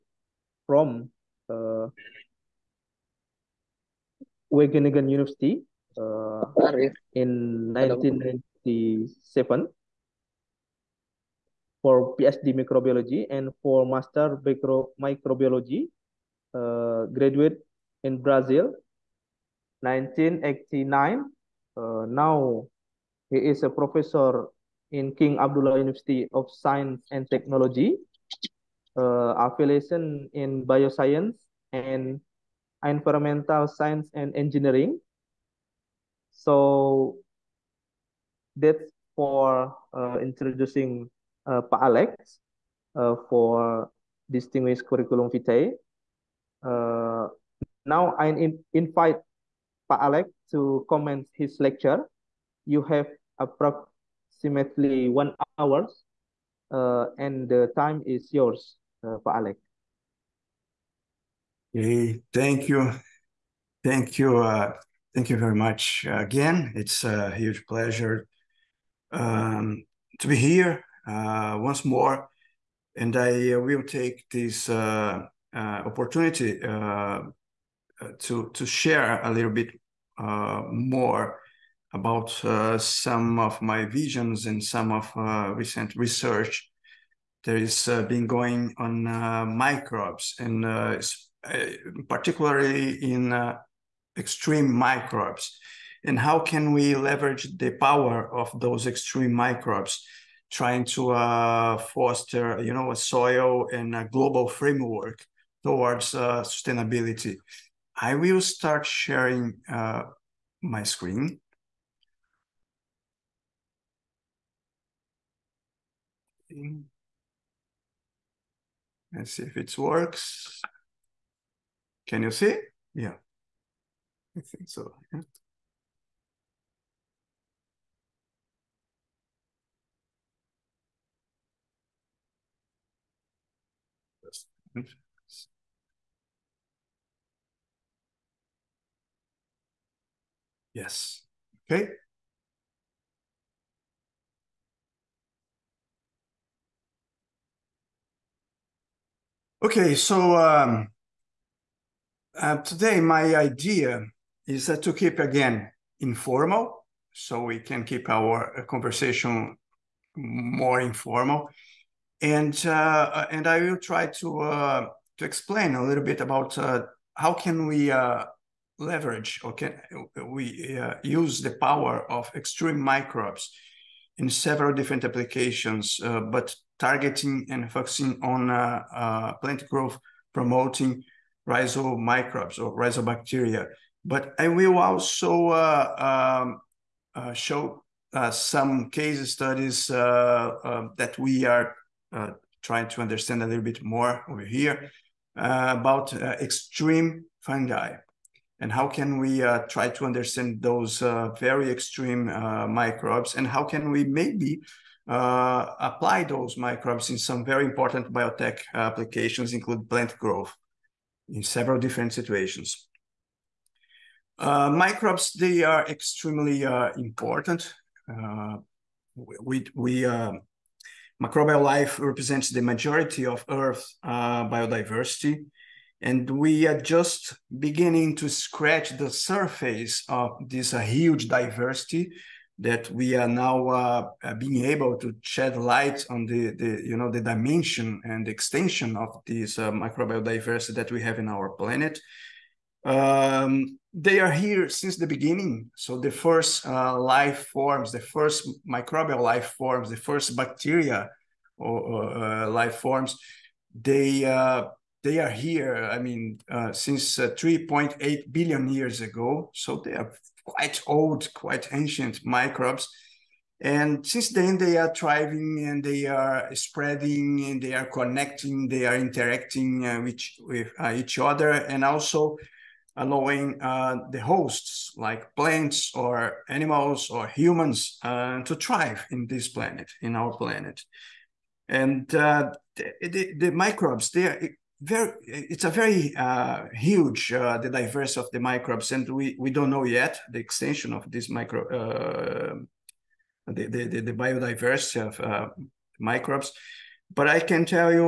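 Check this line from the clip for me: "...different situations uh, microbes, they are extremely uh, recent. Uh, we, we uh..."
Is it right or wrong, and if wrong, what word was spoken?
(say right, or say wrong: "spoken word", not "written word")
wrong: "important", not "recent".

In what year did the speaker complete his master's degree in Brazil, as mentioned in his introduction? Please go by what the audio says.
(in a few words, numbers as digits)
1989.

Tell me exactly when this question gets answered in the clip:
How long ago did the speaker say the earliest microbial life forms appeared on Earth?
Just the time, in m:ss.
4:17.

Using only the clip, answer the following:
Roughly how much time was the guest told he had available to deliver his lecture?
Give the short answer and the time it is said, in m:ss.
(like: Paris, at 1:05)
1 hour, at 0:55.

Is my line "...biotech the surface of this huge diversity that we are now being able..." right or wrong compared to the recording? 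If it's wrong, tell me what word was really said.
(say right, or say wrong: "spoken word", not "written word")
wrong: "scratch", not "biotech".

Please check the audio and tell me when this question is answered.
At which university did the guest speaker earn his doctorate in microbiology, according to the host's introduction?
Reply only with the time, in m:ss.
0:04.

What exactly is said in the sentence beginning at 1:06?
It's a huge pleasure um, to be here uh, once more.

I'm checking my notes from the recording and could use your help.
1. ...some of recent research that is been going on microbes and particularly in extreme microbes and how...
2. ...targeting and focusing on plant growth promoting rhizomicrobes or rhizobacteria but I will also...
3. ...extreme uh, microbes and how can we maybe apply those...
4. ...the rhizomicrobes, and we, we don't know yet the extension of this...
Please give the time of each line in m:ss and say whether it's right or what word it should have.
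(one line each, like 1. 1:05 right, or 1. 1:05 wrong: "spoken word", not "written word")
1. 1:24 right
2. 2:56 right
3. 3:21 right
4. 4:48 wrong: "microbes", not "rhizomicrobes".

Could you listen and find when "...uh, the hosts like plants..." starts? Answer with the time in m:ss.
4:33.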